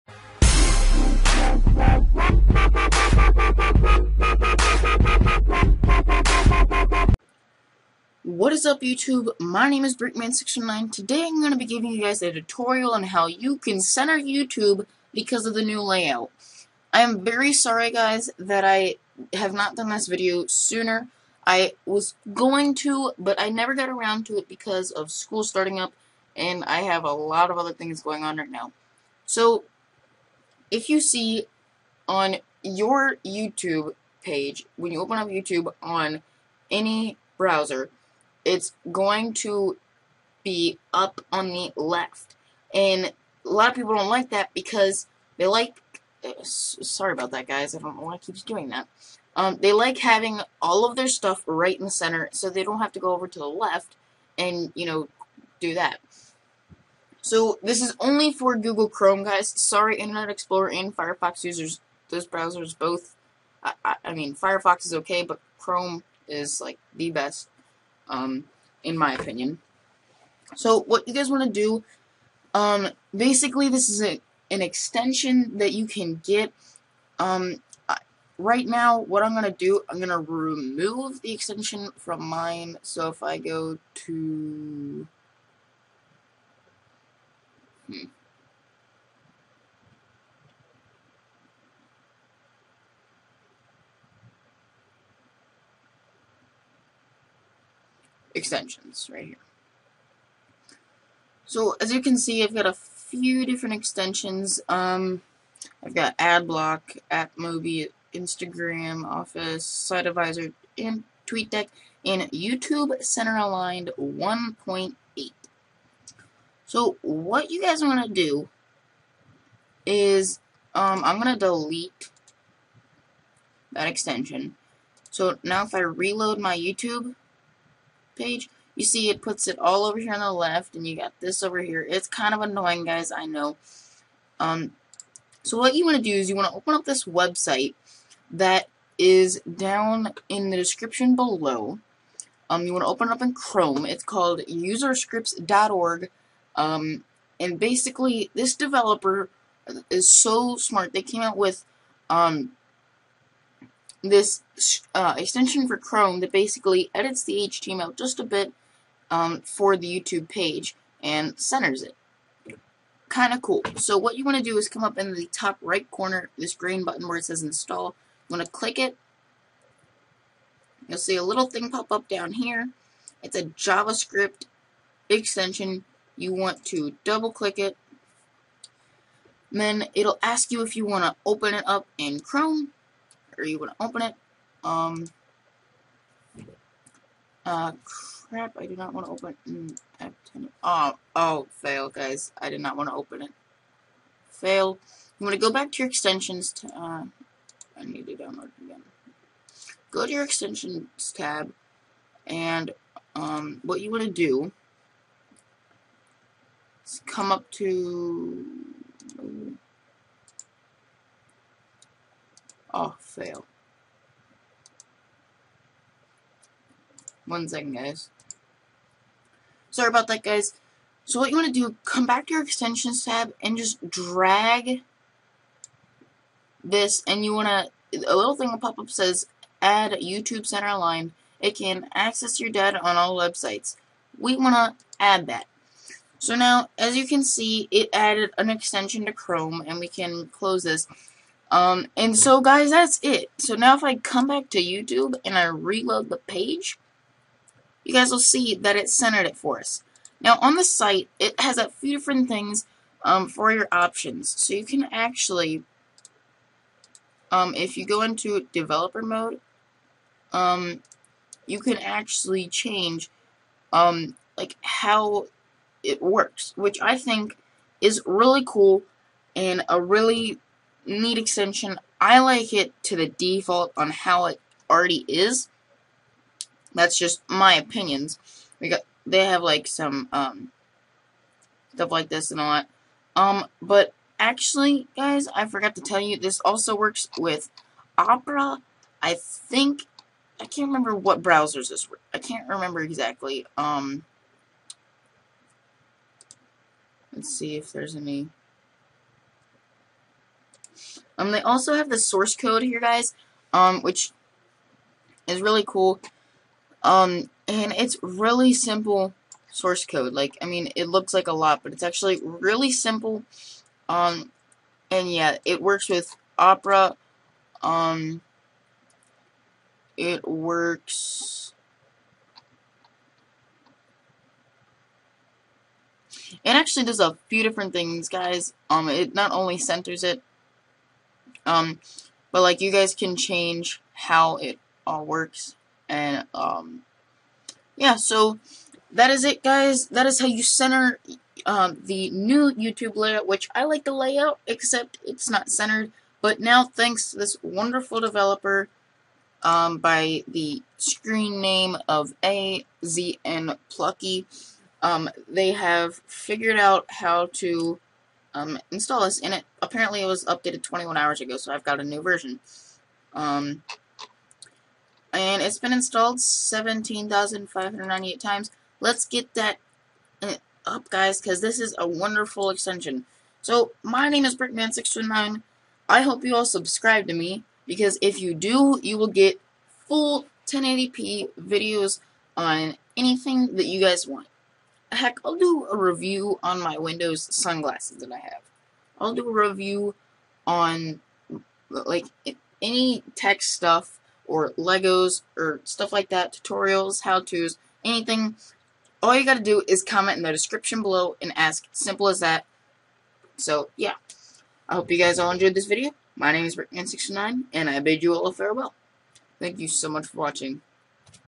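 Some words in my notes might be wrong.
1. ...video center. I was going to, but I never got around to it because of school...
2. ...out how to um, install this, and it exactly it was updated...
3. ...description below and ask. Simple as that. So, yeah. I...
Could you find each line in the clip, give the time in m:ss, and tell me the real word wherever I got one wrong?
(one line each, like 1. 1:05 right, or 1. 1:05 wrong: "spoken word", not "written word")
1. 0:20 wrong: "sooner", not "center"
2. 5:56 wrong: "apparently", not "exactly"
3. 6:40 right.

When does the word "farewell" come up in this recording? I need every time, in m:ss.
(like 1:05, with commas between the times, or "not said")
6:48.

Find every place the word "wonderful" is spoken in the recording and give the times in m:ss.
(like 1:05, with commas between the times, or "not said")
5:47, 6:11.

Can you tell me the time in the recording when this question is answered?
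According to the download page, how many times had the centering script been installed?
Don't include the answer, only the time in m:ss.
6:06.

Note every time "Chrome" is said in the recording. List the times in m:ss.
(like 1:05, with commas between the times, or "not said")
0:58, 1:05, 2:23, 2:35, 3:02, 3:59.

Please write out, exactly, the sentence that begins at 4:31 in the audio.
I like it to the default on how it already is.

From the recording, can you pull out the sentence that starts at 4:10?
Now, on the site, it has a few different things um, for your options.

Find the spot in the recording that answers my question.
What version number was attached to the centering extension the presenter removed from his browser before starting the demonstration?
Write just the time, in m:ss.
1:53.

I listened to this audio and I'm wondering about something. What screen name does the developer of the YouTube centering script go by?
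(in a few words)
AZN Plucky.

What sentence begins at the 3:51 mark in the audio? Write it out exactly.
It can access your data on all websites.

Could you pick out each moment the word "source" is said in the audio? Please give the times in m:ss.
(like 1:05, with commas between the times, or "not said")
5:01, 5:09.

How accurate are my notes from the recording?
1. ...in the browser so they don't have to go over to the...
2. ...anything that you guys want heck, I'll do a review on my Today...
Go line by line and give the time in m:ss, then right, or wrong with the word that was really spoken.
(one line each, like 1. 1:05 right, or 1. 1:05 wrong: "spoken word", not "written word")
1. 0:51 wrong: "center", not "browser"
2. 6:22 wrong: "Windows", not "Today".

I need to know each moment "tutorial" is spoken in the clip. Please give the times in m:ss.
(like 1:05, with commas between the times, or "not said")
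0:12, 6:36.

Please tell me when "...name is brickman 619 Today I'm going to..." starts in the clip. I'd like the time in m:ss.
0:09.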